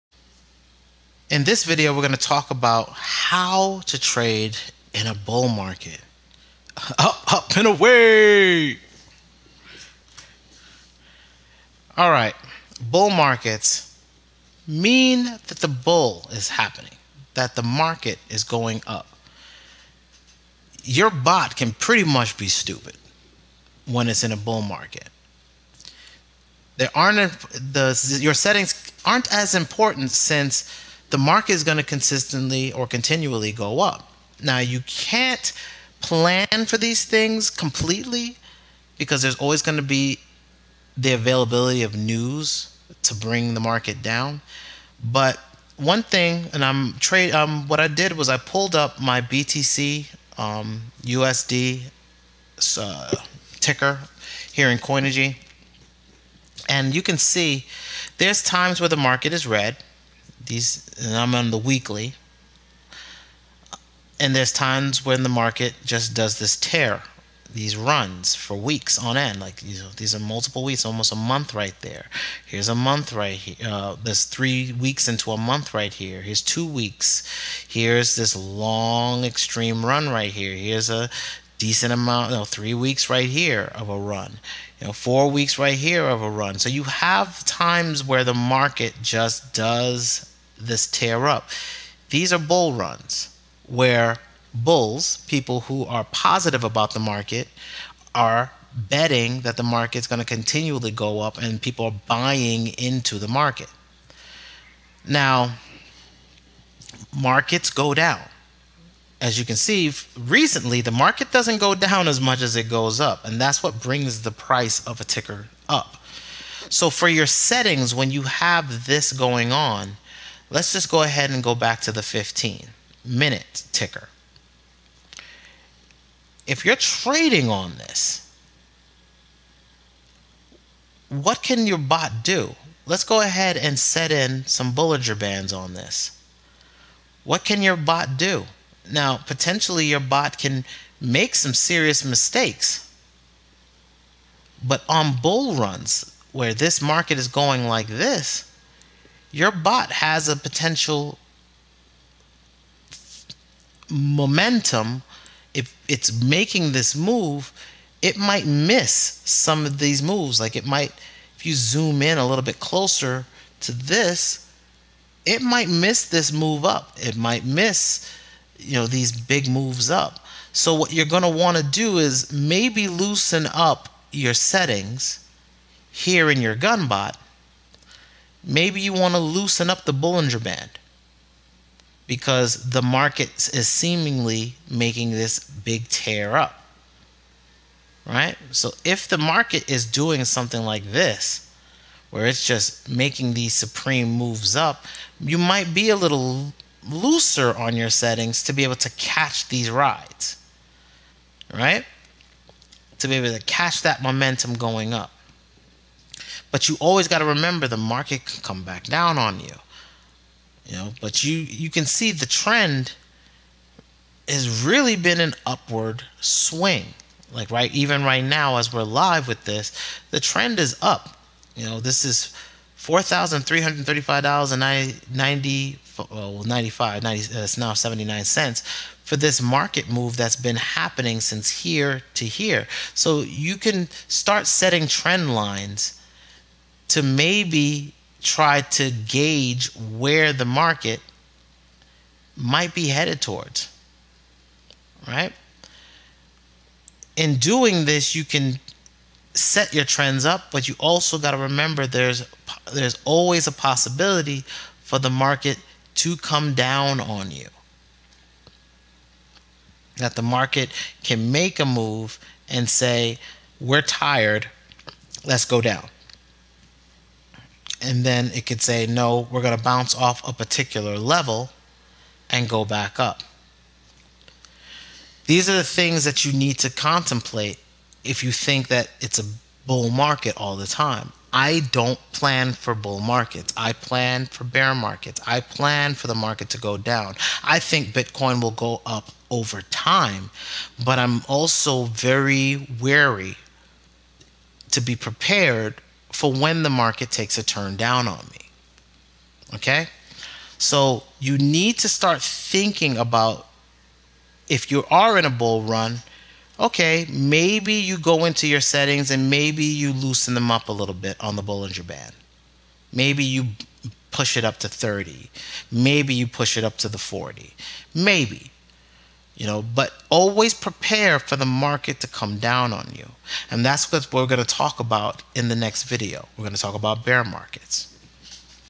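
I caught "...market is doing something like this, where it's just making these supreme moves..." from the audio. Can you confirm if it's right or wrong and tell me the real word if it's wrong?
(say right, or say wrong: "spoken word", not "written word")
right.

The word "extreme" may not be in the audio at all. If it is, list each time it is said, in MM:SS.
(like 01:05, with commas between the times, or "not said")
01:19.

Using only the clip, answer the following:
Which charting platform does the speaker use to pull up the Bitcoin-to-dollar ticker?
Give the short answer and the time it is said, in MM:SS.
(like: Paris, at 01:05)
Coinigy, at 00:54.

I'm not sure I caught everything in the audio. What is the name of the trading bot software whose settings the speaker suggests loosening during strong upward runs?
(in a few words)
Gunbot.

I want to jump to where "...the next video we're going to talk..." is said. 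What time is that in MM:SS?
05:25.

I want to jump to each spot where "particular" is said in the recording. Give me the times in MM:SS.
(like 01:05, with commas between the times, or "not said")
04:30.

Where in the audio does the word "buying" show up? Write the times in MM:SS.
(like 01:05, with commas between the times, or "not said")
01:42.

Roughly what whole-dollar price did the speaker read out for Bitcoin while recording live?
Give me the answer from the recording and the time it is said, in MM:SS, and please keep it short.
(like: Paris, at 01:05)
$4,335, at 03:42.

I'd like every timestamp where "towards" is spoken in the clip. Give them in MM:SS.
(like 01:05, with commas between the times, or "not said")
04:03.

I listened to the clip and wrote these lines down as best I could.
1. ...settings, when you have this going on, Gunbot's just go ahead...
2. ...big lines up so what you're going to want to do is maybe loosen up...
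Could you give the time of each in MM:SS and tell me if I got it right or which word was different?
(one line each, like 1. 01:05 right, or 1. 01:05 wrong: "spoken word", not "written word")
1. 01:57 wrong: "Let", not "Gunbot"
2. 02:49 wrong: "moves", not "lines".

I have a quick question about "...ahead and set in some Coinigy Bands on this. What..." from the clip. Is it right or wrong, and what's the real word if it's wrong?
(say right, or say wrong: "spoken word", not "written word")
wrong: "Bollinger", not "Coinigy".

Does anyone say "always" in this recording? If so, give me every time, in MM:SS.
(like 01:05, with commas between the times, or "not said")
00:39, 03:26, 04:13, 05:20.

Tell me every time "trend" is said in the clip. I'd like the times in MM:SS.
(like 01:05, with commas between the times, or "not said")
03:32, 03:40, 03:54, 04:09.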